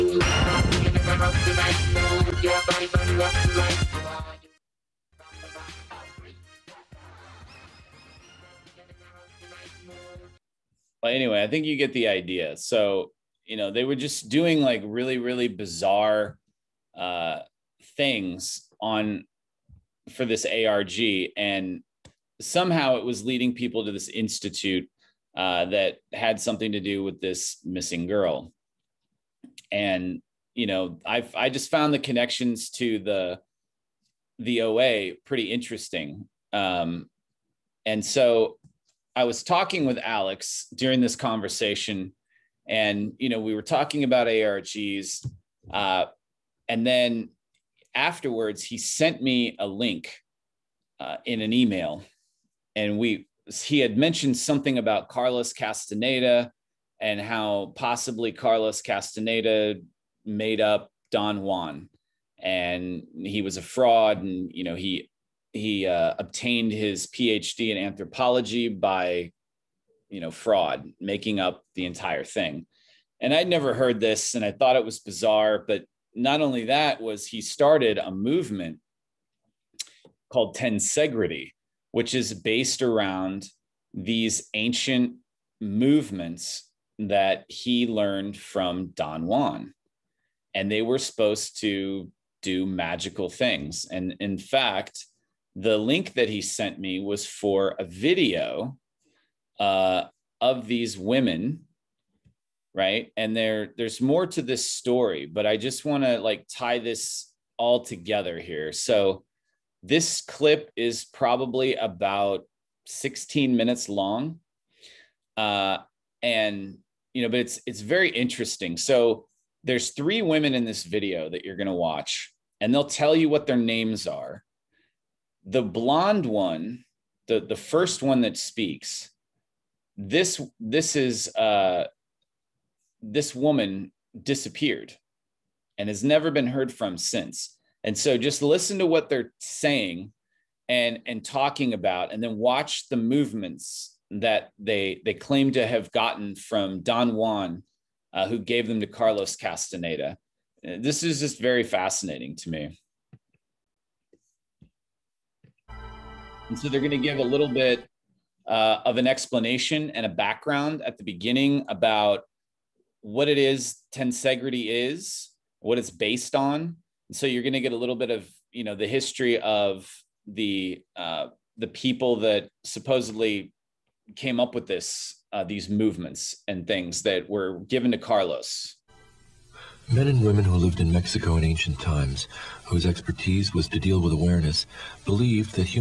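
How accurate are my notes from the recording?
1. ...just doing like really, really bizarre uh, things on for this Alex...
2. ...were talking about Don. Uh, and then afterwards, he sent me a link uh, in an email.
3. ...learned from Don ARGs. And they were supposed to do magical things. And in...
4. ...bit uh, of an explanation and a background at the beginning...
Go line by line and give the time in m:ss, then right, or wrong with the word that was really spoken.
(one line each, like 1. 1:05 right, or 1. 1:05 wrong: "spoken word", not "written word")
1. 0:13 wrong: "ARG", not "Alex"
2. 0:43 wrong: "ARGs", not "Don"
3. 1:27 wrong: "Juan", not "ARGs"
4. 2:37 right.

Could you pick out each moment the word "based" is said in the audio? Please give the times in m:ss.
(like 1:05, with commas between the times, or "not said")
1:22, 2:45.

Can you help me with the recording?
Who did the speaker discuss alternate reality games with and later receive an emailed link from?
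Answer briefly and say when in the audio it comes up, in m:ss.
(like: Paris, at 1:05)
Alex, at 0:40.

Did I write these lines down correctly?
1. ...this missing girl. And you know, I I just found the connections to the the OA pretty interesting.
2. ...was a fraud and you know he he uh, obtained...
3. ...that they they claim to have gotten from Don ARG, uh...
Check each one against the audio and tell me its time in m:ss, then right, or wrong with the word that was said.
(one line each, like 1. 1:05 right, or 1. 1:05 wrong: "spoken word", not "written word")
1. 0:27 right
2. 1:03 right
3. 2:24 wrong: "Juan", not "ARG".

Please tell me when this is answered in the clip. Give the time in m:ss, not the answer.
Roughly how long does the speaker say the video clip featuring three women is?
1:52.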